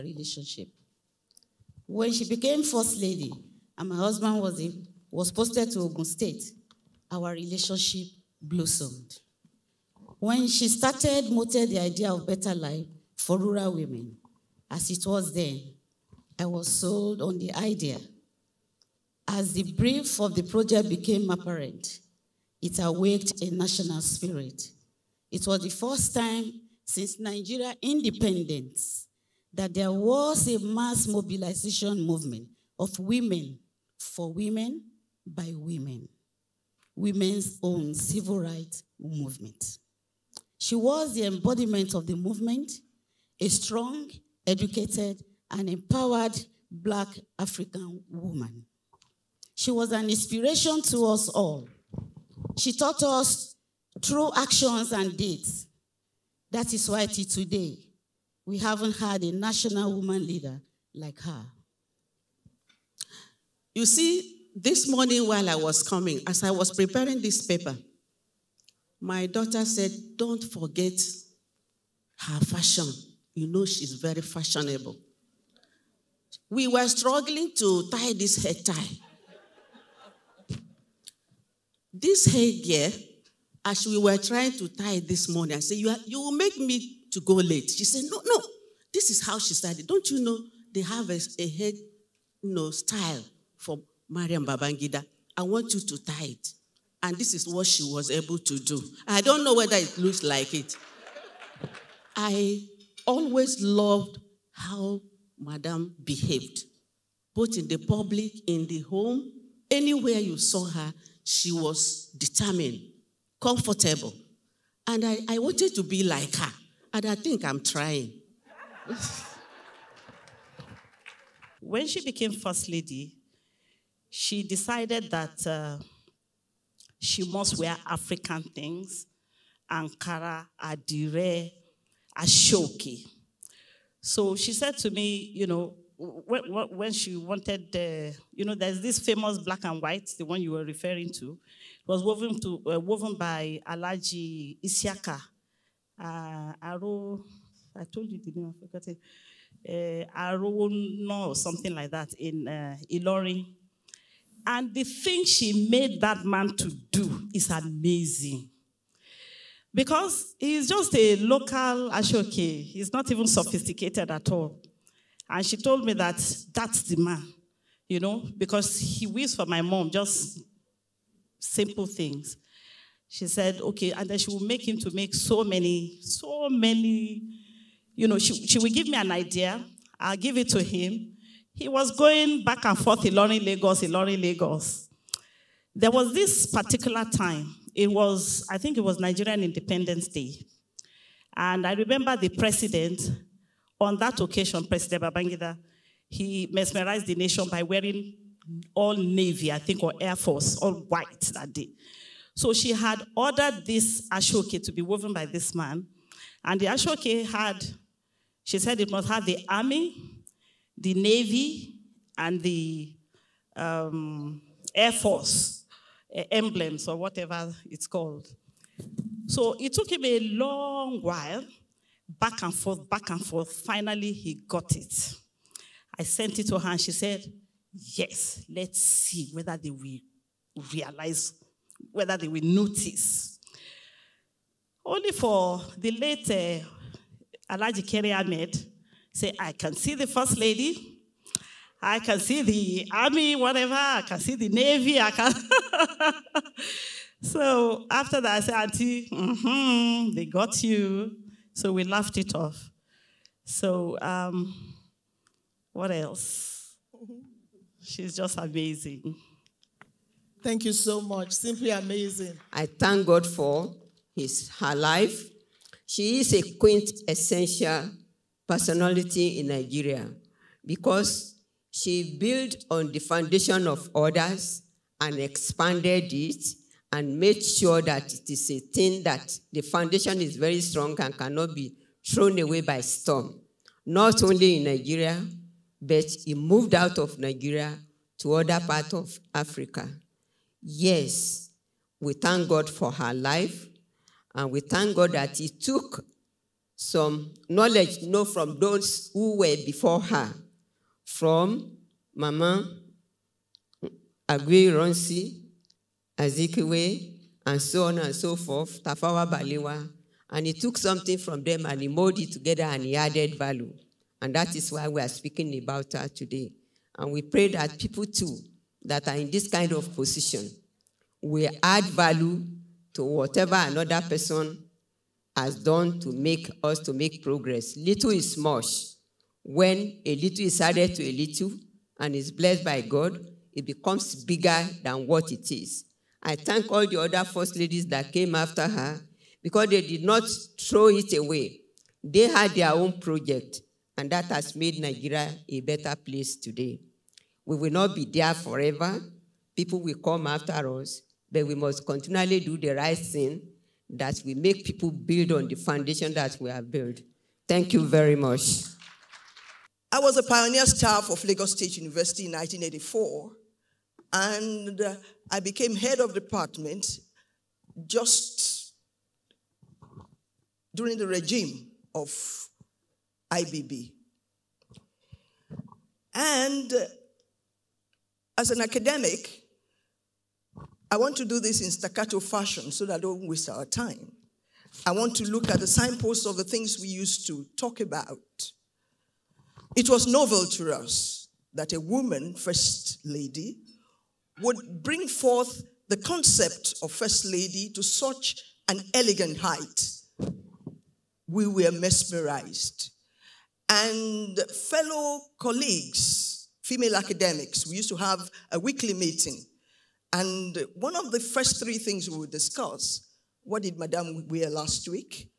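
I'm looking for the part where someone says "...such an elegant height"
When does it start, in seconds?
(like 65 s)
397 s.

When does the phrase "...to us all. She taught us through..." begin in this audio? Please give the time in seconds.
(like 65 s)
50 s.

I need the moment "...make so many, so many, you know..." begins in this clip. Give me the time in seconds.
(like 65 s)
174 s.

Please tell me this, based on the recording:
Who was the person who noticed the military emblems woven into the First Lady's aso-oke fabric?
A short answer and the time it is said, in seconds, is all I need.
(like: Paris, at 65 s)
Alhaji Keri Ahmed, at 237 s.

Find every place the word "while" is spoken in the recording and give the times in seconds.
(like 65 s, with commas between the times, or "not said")
65 s, 221 s.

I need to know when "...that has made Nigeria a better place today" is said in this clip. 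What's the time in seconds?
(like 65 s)
344 s.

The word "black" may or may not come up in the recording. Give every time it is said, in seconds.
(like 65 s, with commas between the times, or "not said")
46 s, 139 s.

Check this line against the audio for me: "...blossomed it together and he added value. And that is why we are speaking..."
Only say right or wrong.
wrong.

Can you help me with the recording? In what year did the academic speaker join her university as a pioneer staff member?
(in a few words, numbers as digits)
1984.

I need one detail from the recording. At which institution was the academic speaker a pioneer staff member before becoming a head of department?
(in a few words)
Lagos State University.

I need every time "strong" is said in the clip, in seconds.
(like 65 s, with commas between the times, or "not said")
43 s, 280 s.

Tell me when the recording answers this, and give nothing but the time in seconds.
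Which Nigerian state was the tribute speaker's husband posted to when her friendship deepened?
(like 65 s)
5 s.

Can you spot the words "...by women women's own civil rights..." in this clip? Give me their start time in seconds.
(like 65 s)
35 s.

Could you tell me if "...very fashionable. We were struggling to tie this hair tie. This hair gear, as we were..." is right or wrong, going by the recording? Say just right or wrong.
right.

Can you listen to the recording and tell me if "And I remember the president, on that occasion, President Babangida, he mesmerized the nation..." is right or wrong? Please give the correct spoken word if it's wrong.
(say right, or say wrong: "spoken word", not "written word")
right.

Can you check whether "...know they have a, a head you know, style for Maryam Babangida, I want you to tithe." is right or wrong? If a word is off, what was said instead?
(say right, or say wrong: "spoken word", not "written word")
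right.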